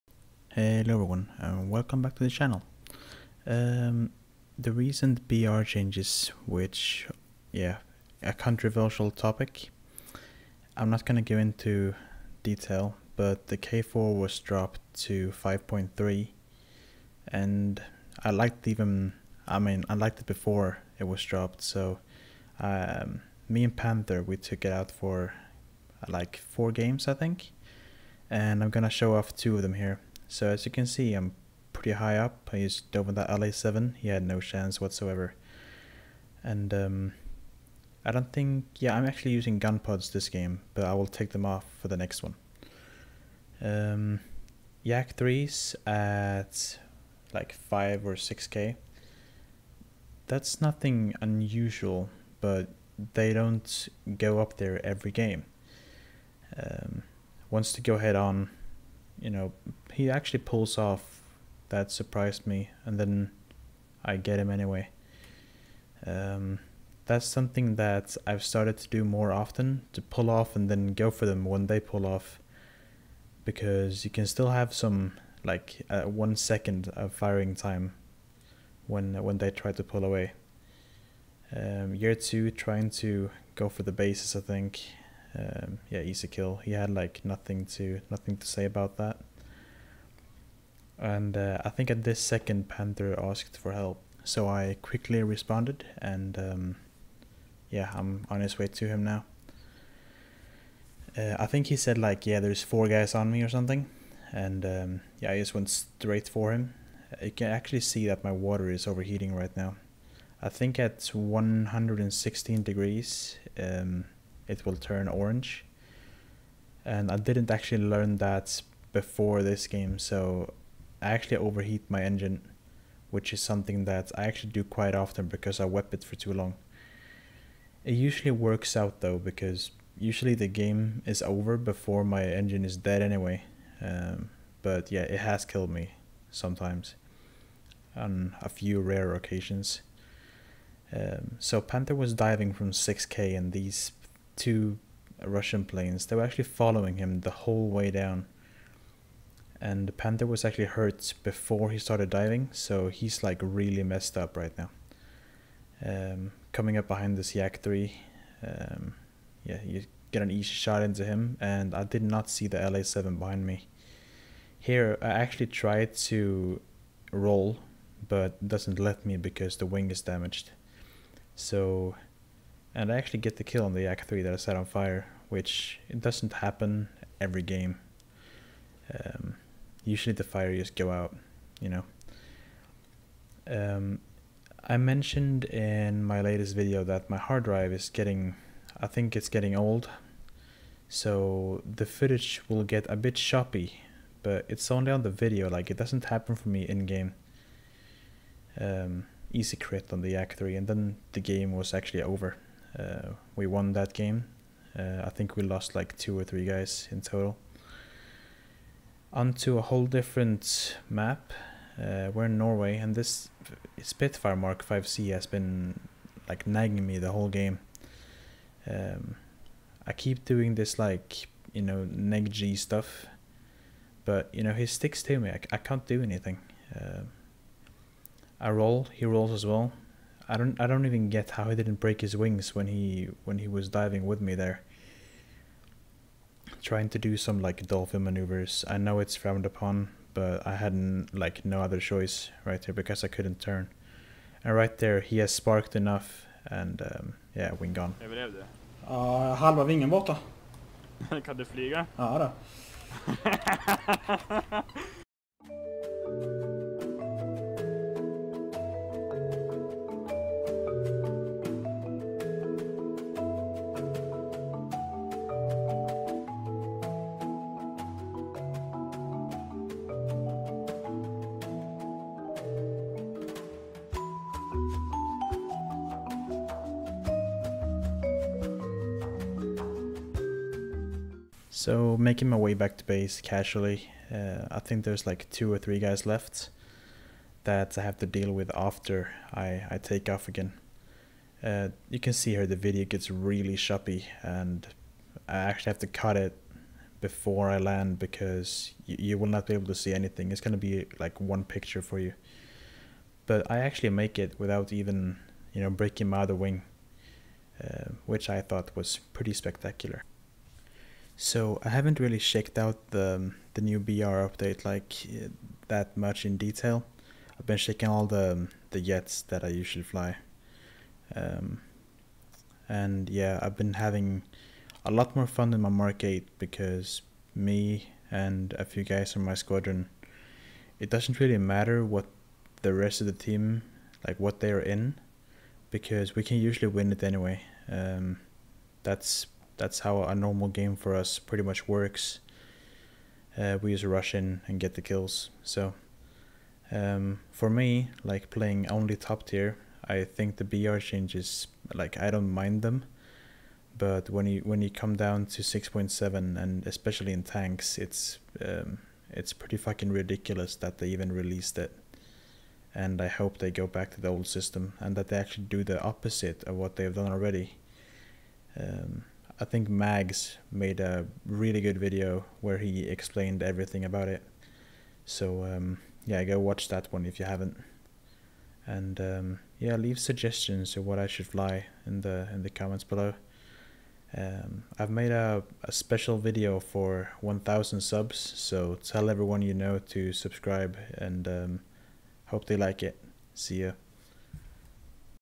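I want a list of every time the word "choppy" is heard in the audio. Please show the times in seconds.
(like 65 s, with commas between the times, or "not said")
193 s, 293 s.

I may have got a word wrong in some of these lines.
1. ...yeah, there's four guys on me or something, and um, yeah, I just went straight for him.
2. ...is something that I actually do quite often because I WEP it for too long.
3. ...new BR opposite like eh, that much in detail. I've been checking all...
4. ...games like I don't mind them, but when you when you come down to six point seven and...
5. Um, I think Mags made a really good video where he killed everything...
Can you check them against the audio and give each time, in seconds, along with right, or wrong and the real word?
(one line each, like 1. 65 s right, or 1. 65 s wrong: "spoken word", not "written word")
1. 102 s right
2. 123 s right
3. 313 s wrong: "update", not "opposite"
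4. 350 s wrong: "changes", not "games"
5. 368 s wrong: "explained", not "killed".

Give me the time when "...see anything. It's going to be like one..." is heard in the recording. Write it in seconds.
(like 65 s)
299 s.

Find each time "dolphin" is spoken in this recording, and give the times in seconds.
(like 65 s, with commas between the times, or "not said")
237 s.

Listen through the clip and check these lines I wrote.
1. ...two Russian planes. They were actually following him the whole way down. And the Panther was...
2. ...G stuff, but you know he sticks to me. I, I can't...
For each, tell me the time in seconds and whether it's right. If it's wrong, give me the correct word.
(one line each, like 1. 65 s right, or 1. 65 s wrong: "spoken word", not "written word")
1. 144 s right
2. 222 s right.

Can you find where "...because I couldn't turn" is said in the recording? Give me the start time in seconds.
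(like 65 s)
242 s.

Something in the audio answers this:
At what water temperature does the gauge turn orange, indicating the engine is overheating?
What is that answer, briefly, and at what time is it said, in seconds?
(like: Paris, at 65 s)
116 degrees, at 111 s.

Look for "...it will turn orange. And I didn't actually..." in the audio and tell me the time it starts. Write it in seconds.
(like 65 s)
114 s.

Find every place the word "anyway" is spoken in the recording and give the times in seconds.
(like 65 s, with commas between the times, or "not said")
64 s, 133 s, 337 s.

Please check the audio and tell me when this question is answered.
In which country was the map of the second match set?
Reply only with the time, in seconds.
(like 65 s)
212 s.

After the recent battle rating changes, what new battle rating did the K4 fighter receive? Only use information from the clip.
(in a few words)
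5.3.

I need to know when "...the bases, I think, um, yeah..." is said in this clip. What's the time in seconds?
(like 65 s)
83 s.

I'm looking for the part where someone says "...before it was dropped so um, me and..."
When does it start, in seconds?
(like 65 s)
20 s.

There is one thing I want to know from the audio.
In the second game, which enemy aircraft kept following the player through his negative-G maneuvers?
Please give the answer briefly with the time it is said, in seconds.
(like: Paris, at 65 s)
Spitfire Mark 5C, at 213 s.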